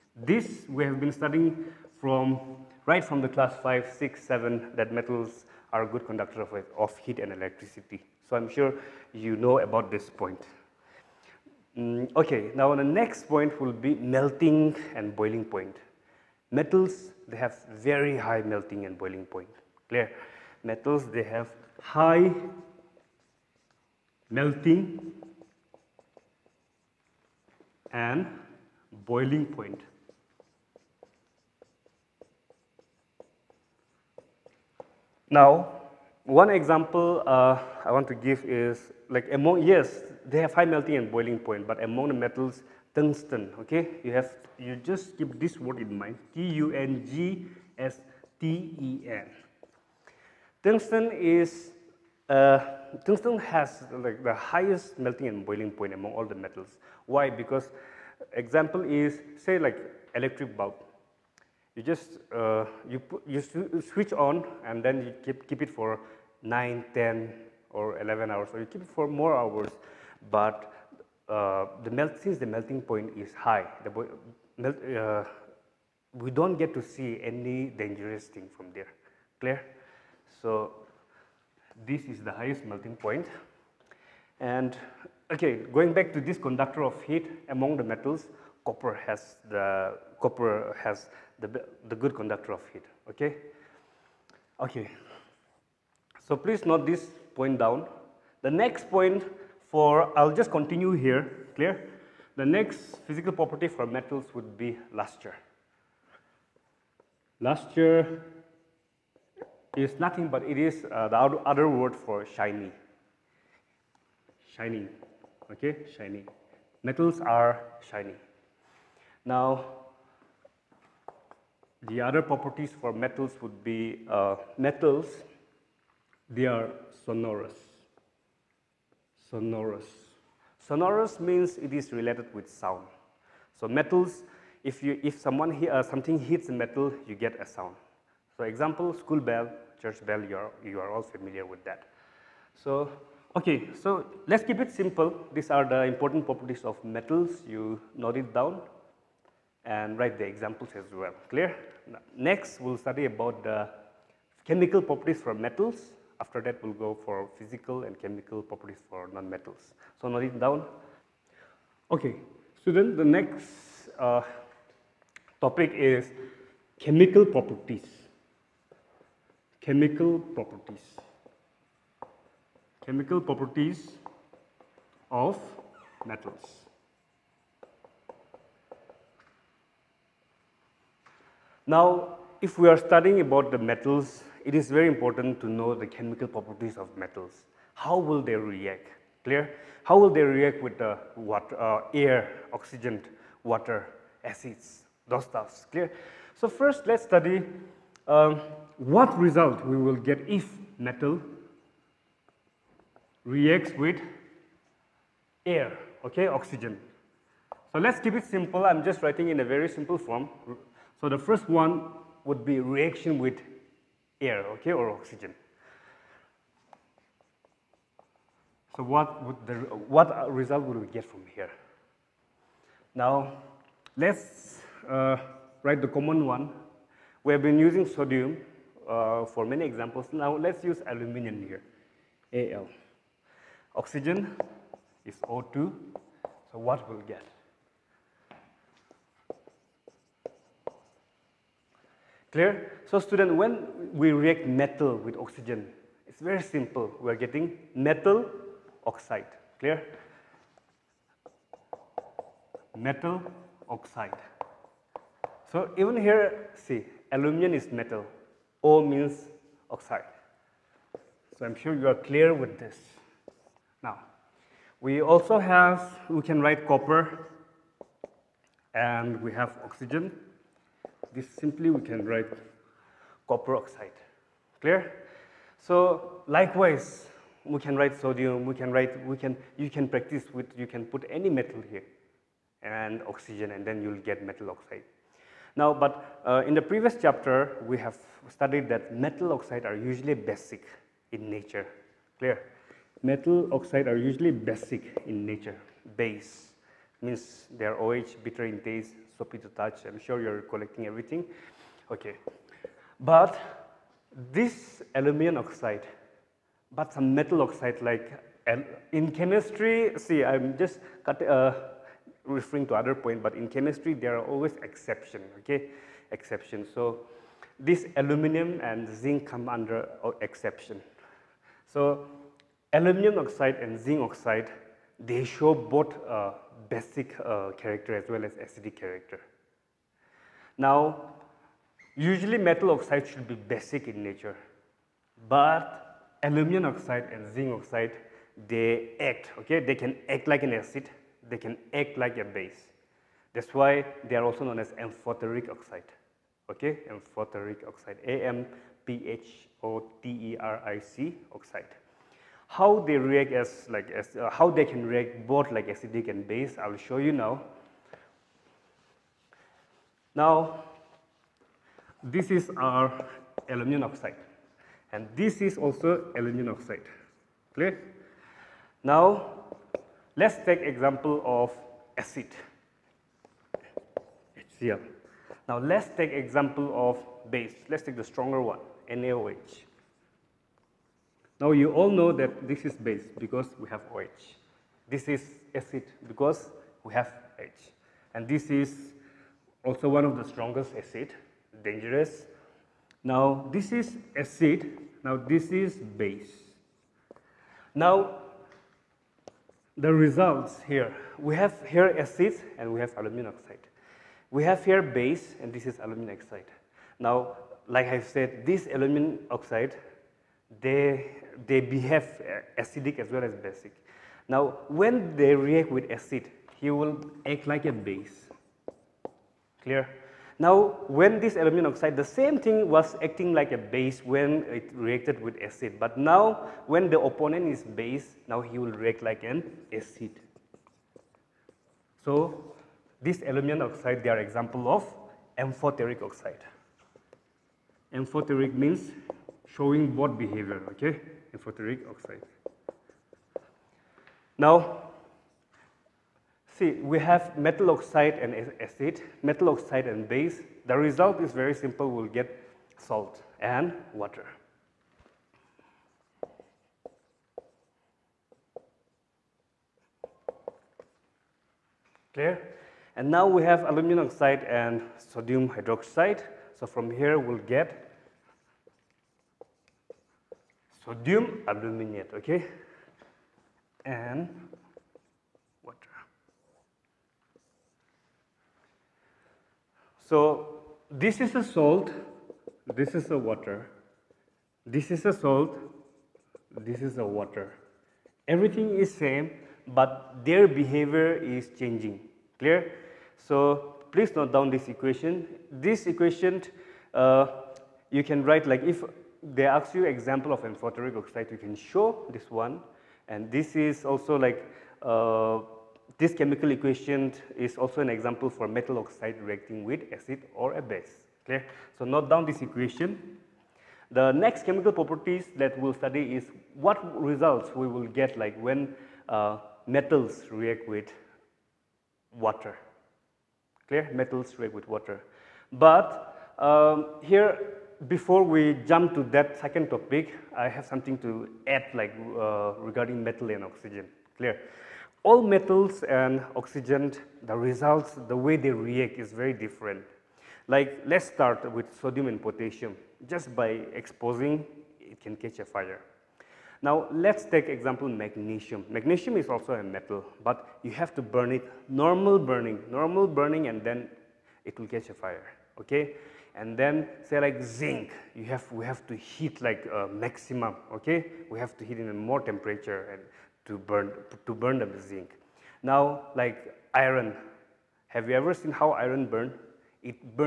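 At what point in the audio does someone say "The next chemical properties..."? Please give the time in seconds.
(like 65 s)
513 s.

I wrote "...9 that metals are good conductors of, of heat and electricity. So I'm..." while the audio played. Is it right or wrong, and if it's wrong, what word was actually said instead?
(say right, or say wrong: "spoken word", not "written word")
wrong: "7", not "9".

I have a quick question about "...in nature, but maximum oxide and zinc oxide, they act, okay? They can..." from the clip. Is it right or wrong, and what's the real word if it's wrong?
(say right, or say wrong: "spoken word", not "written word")
wrong: "aluminum", not "maximum".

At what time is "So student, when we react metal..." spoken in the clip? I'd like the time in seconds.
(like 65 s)
242 s.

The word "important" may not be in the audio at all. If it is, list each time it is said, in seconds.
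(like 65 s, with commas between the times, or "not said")
145 s, 184 s.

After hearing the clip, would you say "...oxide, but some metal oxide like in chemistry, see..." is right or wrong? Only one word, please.
right.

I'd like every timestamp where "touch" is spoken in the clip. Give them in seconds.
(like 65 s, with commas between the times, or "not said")
299 s.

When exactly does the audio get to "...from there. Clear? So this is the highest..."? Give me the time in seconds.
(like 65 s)
78 s.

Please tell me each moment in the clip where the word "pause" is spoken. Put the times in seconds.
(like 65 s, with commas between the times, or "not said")
not said.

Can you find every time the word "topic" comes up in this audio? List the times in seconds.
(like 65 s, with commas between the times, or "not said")
165 s, 529 s.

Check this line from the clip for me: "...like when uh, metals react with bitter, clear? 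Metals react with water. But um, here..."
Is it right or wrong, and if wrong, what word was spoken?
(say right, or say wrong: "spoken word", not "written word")
wrong: "water", not "bitter".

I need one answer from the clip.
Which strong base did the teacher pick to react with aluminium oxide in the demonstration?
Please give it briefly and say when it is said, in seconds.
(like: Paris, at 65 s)
NaOH, at 378 s.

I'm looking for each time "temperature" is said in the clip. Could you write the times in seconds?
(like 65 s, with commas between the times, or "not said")
562 s.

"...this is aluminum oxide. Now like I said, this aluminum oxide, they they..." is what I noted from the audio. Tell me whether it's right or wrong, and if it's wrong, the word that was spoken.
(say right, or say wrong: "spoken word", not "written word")
right.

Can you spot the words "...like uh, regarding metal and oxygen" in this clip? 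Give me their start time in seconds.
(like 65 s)
531 s.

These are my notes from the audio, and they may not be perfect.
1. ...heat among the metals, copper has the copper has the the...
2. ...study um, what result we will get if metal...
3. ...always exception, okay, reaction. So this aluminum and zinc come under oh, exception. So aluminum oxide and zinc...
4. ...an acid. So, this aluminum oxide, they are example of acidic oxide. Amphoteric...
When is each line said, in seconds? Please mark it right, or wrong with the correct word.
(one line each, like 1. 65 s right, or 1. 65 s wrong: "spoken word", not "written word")
1. 87 s right
2. 197 s right
3. 314 s wrong: "exception", not "reaction"
4. 429 s wrong: "amphoteric", not "acidic".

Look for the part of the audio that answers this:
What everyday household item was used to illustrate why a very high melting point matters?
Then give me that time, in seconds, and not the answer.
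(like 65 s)
60 s.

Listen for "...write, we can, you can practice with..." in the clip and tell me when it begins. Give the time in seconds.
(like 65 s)
278 s.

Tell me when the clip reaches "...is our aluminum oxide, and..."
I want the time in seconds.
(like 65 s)
362 s.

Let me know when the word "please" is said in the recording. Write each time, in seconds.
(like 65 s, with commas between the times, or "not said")
96 s, 493 s.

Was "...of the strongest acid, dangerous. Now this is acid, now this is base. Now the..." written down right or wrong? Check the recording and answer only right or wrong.
right.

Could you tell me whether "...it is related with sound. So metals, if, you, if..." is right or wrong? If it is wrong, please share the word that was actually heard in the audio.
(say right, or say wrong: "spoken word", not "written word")
right.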